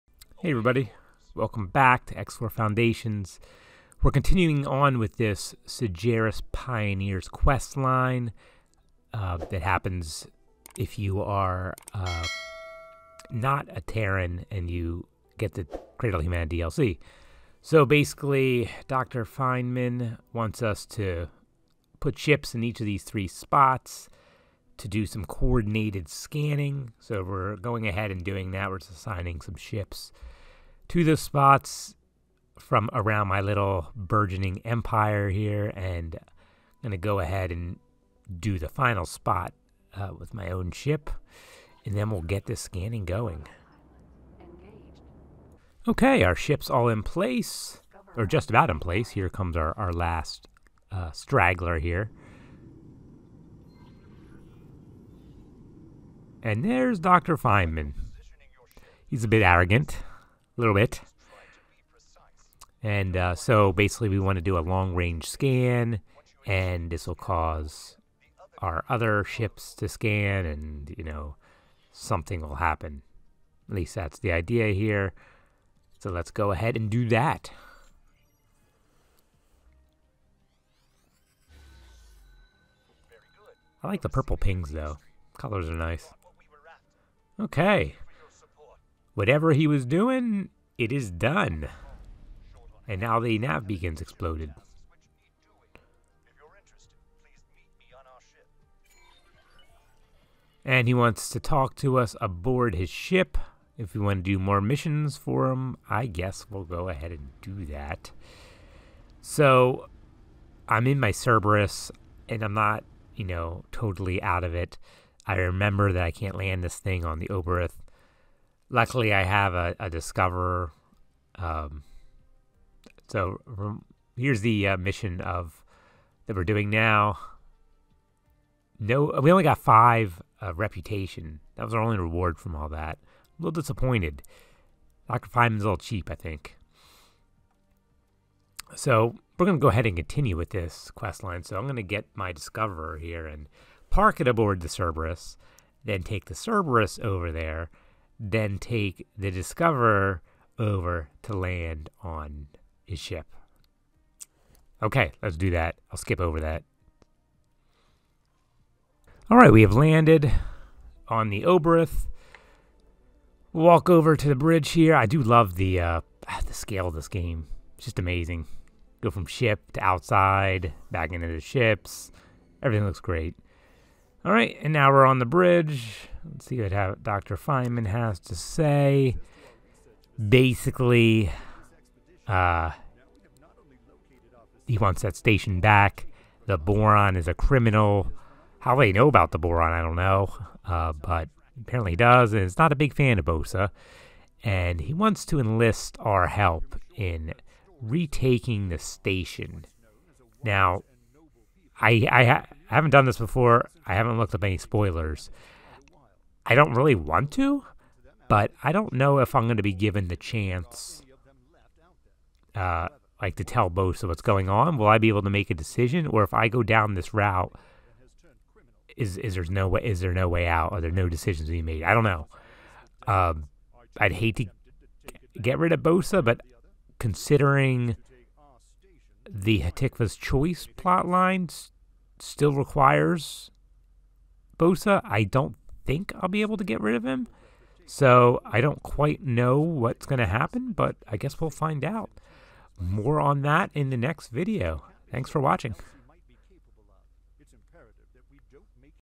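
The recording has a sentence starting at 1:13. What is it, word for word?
At least that's the idea here.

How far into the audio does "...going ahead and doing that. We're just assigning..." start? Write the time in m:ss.
0:27.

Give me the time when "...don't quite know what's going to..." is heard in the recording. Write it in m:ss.
3:58.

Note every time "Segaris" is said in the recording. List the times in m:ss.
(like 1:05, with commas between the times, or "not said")
0:05.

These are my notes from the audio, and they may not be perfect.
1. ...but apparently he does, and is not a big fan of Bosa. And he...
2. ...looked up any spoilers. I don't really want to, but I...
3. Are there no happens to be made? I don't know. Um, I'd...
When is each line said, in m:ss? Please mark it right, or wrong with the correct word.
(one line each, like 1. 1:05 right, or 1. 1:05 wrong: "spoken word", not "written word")
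1. 3:10 right
2. 3:24 right
3. 3:40 wrong: "decisions", not "happens".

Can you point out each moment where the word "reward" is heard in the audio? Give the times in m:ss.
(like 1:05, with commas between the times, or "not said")
2:11.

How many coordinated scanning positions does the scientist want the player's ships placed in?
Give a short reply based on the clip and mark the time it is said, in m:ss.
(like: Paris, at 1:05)
3, at 0:23.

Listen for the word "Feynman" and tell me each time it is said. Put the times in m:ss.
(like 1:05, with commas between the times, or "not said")
0:19, 0:57, 2:15, 2:57.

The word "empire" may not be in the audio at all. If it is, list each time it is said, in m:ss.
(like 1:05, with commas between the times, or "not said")
0:34.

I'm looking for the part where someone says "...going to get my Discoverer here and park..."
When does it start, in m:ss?
2:21.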